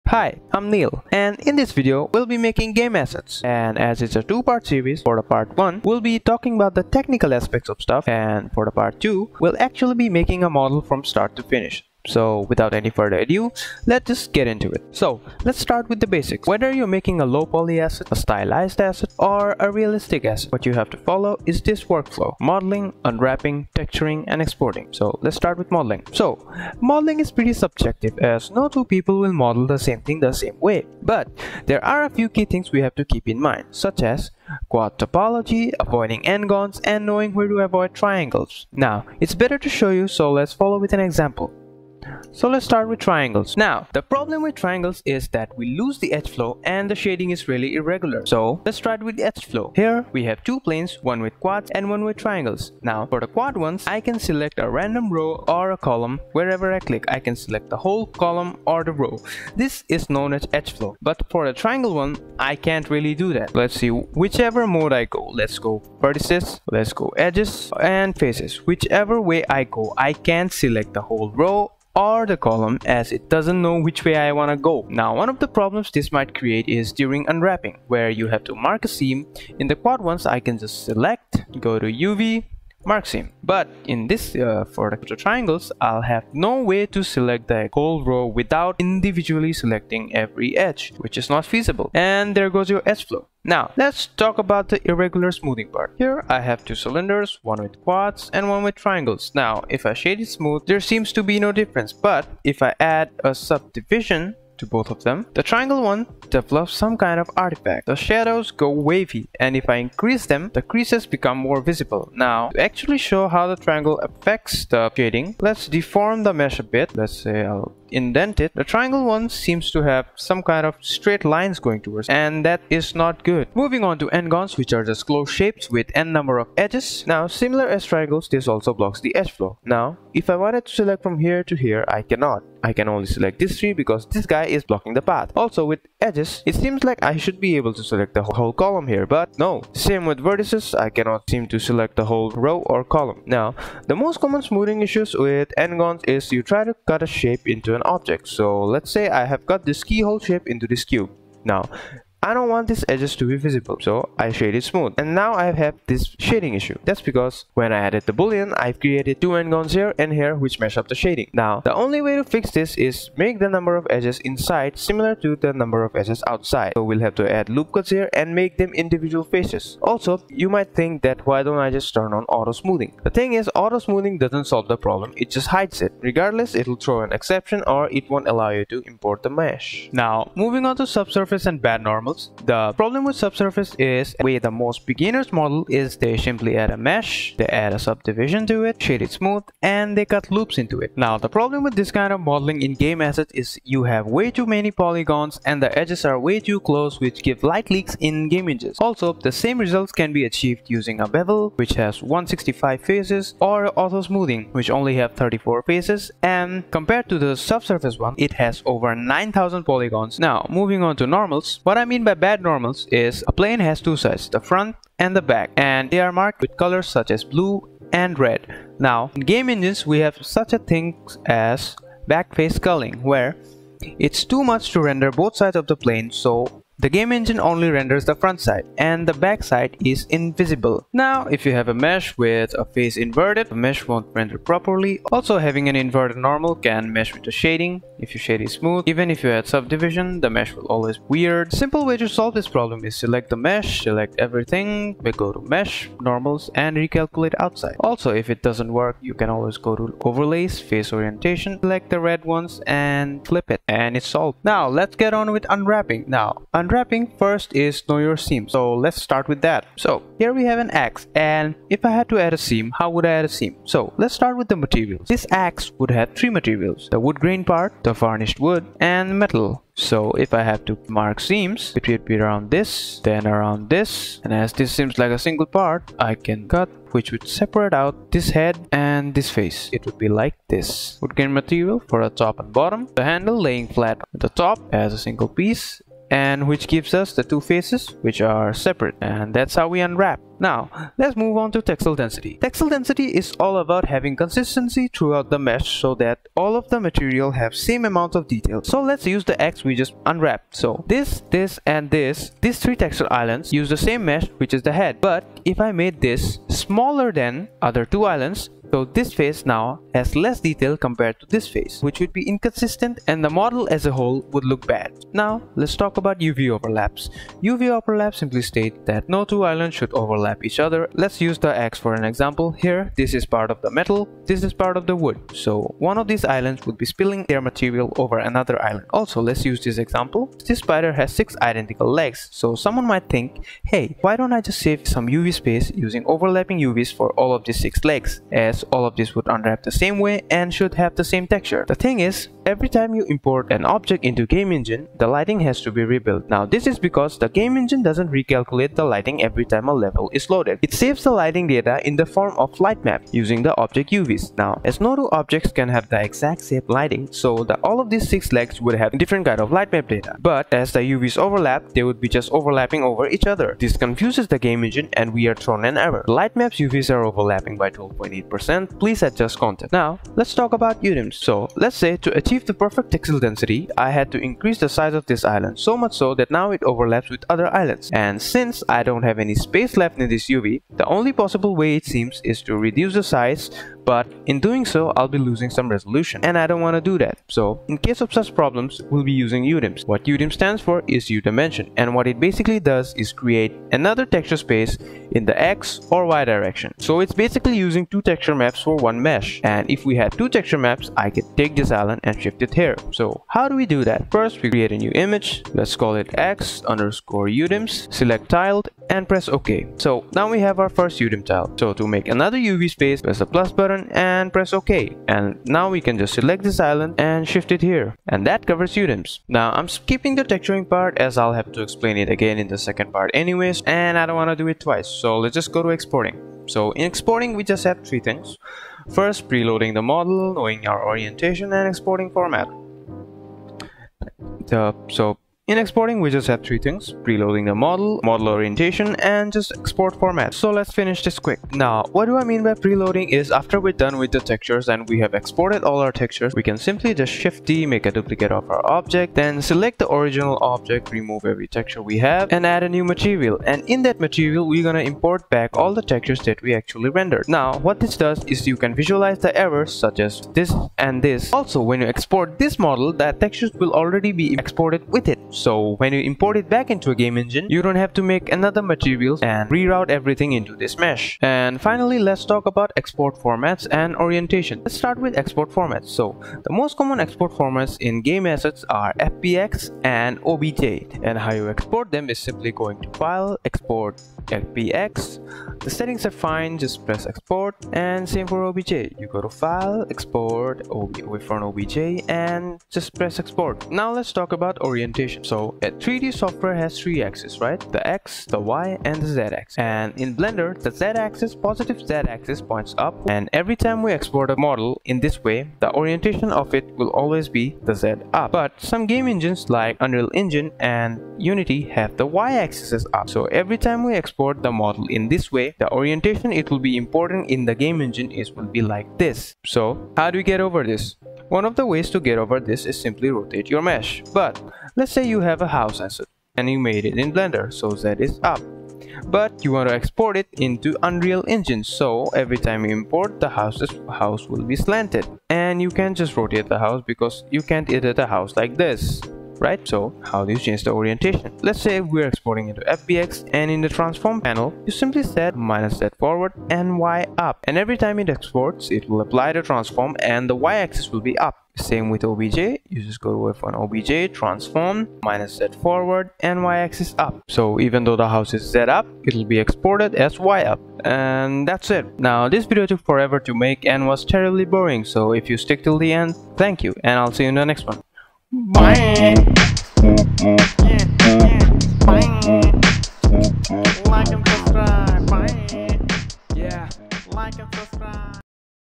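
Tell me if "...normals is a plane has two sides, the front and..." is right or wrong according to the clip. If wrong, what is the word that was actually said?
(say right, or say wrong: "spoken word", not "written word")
right.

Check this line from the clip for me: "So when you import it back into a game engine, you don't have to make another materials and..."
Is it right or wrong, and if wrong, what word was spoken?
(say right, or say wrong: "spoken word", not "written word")
right.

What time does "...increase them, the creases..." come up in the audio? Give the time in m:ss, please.
1:49.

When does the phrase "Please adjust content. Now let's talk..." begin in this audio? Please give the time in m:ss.
6:08.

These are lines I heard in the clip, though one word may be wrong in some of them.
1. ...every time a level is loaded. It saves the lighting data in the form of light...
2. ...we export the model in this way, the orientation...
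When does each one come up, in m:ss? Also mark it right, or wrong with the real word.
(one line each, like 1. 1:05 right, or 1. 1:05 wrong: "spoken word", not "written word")
1. 5:49 right
2. 8:33 right.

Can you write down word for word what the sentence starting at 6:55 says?
And now we can just select this island and shift it here.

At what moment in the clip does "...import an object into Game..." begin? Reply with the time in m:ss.
5:43.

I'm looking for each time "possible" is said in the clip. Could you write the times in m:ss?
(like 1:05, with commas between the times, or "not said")
6:21.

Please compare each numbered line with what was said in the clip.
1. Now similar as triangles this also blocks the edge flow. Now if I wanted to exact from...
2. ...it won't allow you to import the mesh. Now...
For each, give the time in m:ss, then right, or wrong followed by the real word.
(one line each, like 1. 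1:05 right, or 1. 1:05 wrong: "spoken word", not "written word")
1. 2:07 wrong: "select", not "exact"
2. 2:57 right.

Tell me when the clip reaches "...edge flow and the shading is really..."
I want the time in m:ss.
0:46.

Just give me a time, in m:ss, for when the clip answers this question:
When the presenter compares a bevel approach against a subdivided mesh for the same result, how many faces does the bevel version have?
3:22.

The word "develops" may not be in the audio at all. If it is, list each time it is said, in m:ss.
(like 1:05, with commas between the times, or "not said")
1:46.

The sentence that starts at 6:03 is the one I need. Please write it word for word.
This confuses the Game Engine and we are thrown an error.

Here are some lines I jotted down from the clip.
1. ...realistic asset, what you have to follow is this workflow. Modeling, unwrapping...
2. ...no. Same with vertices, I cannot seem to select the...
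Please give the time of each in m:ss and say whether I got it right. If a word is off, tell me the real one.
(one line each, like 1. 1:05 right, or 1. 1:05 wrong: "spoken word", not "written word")
1. 0:19 right
2. 2:19 right.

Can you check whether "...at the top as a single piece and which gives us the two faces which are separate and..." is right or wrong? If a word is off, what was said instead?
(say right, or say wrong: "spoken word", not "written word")
right.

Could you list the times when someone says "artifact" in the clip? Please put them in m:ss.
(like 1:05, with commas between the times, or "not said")
1:47.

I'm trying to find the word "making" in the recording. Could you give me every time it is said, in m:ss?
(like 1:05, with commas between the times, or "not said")
0:02, 0:10, 0:16.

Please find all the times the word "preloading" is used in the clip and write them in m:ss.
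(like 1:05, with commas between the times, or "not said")
7:09, 7:17, 7:22.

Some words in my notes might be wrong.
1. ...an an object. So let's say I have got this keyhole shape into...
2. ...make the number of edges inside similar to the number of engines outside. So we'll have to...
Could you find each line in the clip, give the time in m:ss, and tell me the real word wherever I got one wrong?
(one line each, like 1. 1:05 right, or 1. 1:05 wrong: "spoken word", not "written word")
1. 2:27 right
2. 2:43 wrong: "edges", not "engines".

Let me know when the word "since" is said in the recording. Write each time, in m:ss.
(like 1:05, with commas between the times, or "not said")
6:18.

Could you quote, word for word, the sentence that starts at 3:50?
Now if you have a mesh with a face inverted, the mesh won't render properly.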